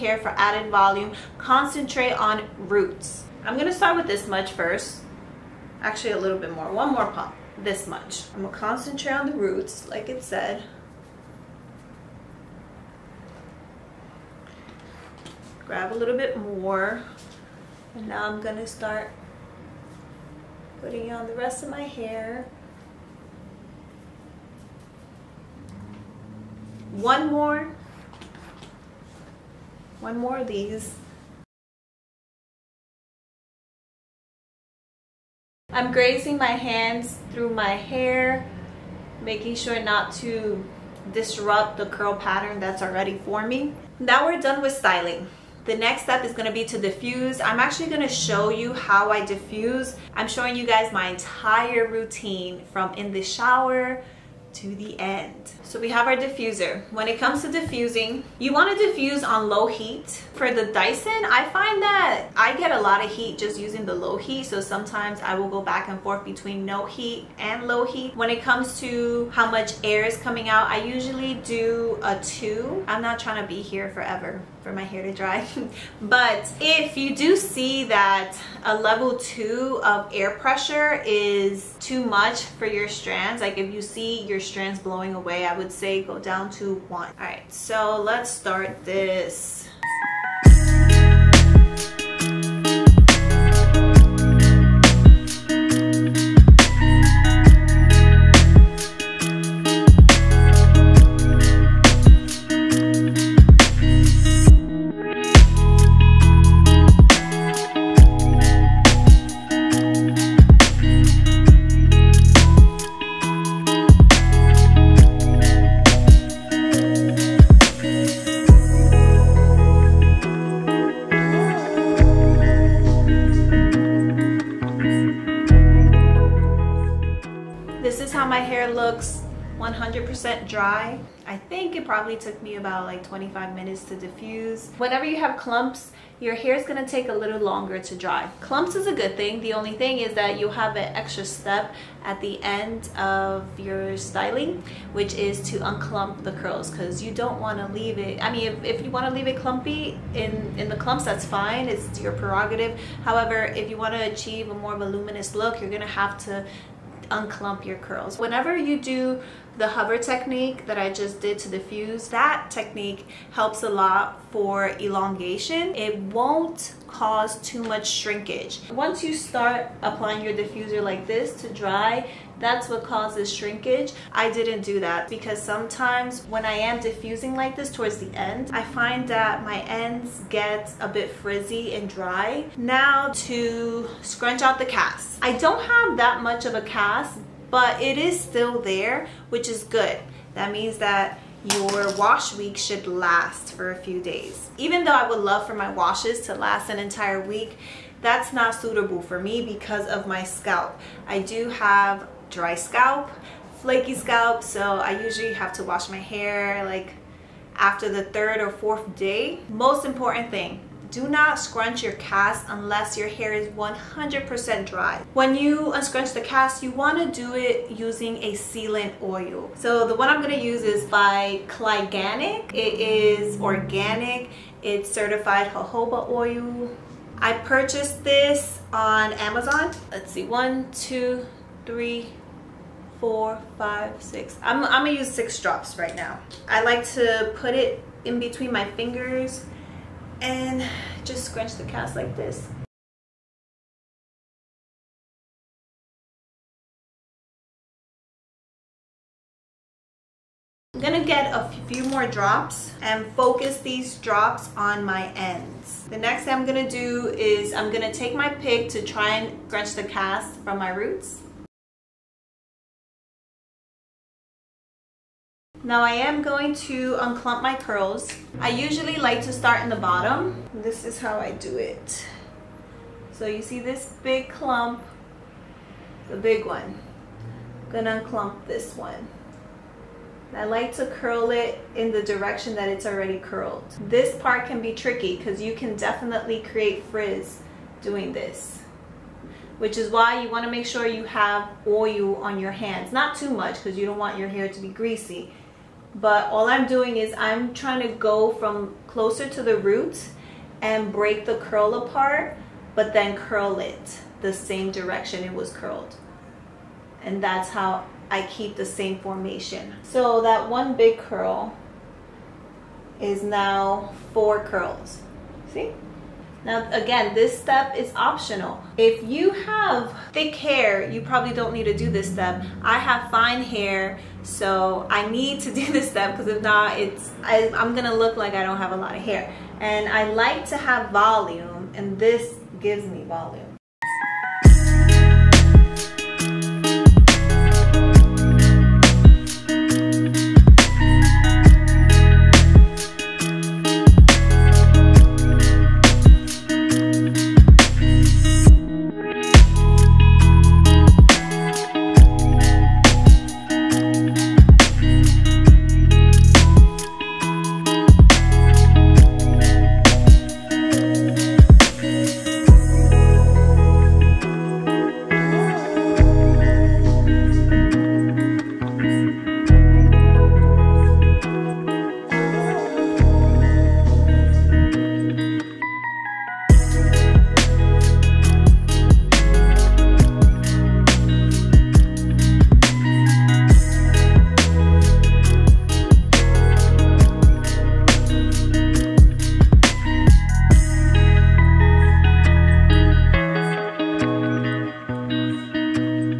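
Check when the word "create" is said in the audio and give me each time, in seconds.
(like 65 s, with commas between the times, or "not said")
286 s.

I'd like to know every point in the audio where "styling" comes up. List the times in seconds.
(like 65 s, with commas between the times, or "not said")
44 s, 143 s.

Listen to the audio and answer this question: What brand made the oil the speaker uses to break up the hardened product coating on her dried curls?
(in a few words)
Cliganic.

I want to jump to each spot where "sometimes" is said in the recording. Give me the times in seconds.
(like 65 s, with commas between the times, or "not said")
64 s, 175 s.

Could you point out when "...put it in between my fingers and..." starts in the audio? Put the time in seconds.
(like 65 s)
237 s.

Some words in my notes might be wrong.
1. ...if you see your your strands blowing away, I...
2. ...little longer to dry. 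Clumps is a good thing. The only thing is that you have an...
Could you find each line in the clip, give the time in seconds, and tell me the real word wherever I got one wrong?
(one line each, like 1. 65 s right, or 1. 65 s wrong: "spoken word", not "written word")
1. 83 s right
2. 137 s right.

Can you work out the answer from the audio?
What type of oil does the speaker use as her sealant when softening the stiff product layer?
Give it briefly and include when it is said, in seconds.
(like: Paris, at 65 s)
Jojoba oil, at 225 s.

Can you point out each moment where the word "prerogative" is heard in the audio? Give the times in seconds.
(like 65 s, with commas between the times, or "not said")
152 s.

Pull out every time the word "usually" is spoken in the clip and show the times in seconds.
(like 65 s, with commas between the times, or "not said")
70 s, 205 s, 268 s.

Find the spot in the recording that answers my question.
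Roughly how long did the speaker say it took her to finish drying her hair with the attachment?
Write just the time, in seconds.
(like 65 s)
133 s.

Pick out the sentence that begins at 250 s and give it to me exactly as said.
I'm gonna get a few more drops and focus these drops on my ends.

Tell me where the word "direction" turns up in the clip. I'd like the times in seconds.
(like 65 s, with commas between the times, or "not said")
282 s, 304 s.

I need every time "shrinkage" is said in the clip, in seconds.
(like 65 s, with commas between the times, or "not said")
167 s, 173 s.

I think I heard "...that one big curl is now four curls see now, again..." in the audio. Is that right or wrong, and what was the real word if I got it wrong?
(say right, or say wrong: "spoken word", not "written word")
right.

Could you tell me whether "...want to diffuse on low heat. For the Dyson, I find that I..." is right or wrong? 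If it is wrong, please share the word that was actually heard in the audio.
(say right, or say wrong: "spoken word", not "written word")
right.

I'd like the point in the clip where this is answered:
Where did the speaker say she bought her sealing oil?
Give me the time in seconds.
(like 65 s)
229 s.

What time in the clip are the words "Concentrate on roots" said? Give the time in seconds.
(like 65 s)
1 s.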